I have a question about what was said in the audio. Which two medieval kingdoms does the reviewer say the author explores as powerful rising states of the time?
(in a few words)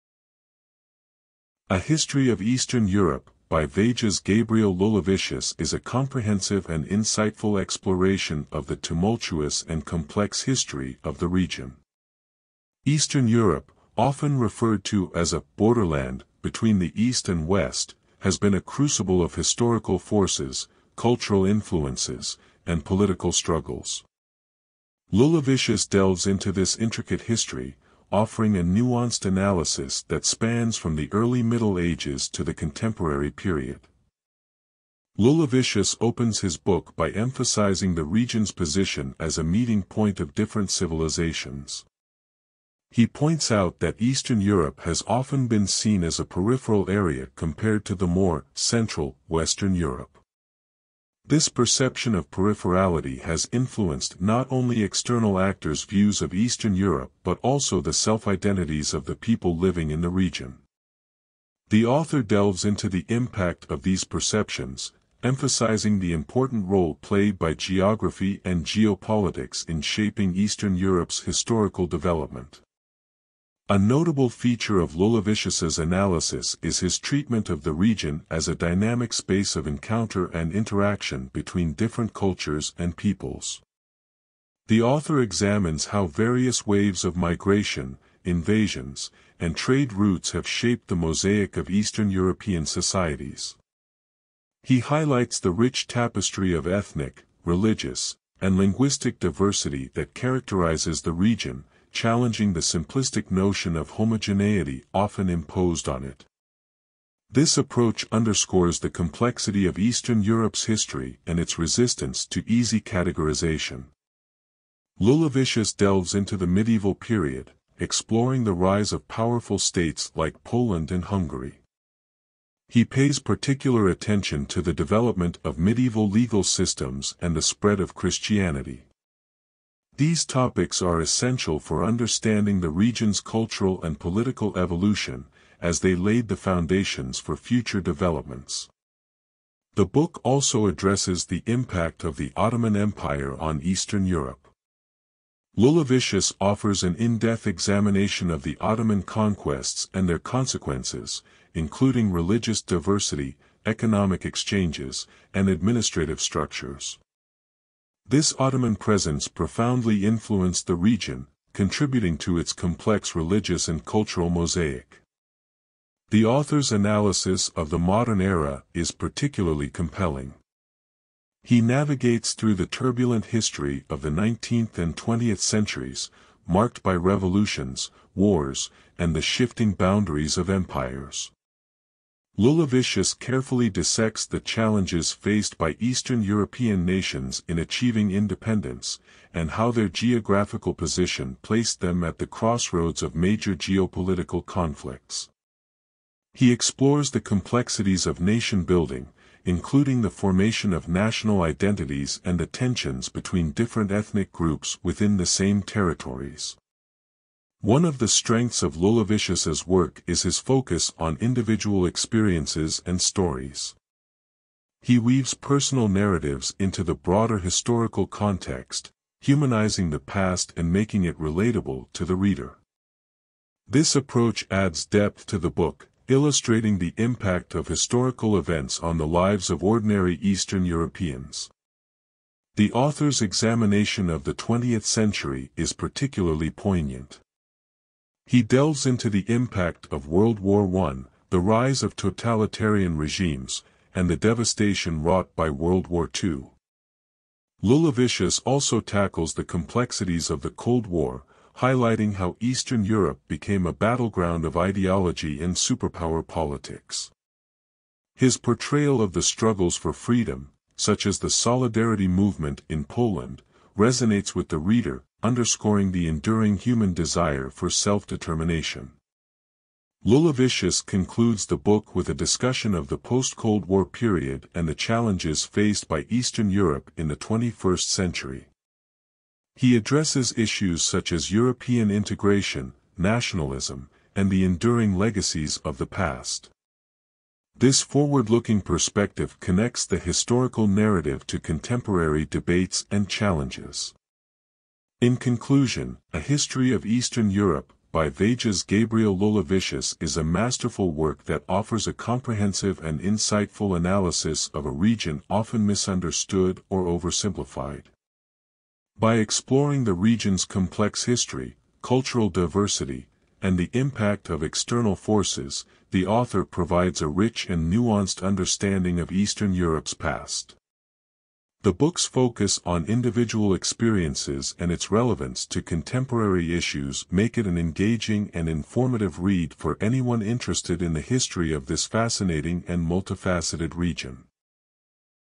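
Poland and Hungary.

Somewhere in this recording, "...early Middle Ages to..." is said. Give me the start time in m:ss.
0:31.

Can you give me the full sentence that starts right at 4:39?
He addresses issues such as European integration, nationalism, and the enduring legacies of the past.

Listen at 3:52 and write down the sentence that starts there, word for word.
The author's examination of the 20th century is particularly poignant.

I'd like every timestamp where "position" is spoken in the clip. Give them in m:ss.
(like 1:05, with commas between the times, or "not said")
0:38, 3:10.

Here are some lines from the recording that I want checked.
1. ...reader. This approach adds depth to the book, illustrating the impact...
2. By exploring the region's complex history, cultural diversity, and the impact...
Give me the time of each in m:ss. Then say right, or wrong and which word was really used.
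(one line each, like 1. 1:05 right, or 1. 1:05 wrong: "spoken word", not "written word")
1. 3:42 right
2. 5:08 right.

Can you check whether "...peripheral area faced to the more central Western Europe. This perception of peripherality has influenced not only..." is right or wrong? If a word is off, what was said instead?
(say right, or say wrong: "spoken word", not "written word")
wrong: "compared", not "faced".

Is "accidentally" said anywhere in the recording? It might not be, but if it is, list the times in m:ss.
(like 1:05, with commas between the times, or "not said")
not said.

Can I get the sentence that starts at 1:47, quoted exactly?
This approach underscores the complexity of Eastern Europe's history and its resistance to easy categorization.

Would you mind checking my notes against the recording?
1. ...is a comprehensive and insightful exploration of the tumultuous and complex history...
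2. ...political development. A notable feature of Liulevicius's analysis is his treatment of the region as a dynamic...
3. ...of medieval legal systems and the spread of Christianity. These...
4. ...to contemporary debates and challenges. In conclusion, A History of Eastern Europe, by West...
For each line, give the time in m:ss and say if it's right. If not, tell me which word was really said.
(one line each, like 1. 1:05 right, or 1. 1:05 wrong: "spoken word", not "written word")
1. 0:05 right
2. 1:11 wrong: "historical", not "political"
3. 2:05 right
4. 4:51 wrong: "Vejas", not "West".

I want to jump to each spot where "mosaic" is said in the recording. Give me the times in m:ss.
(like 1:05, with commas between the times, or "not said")
1:30, 2:44.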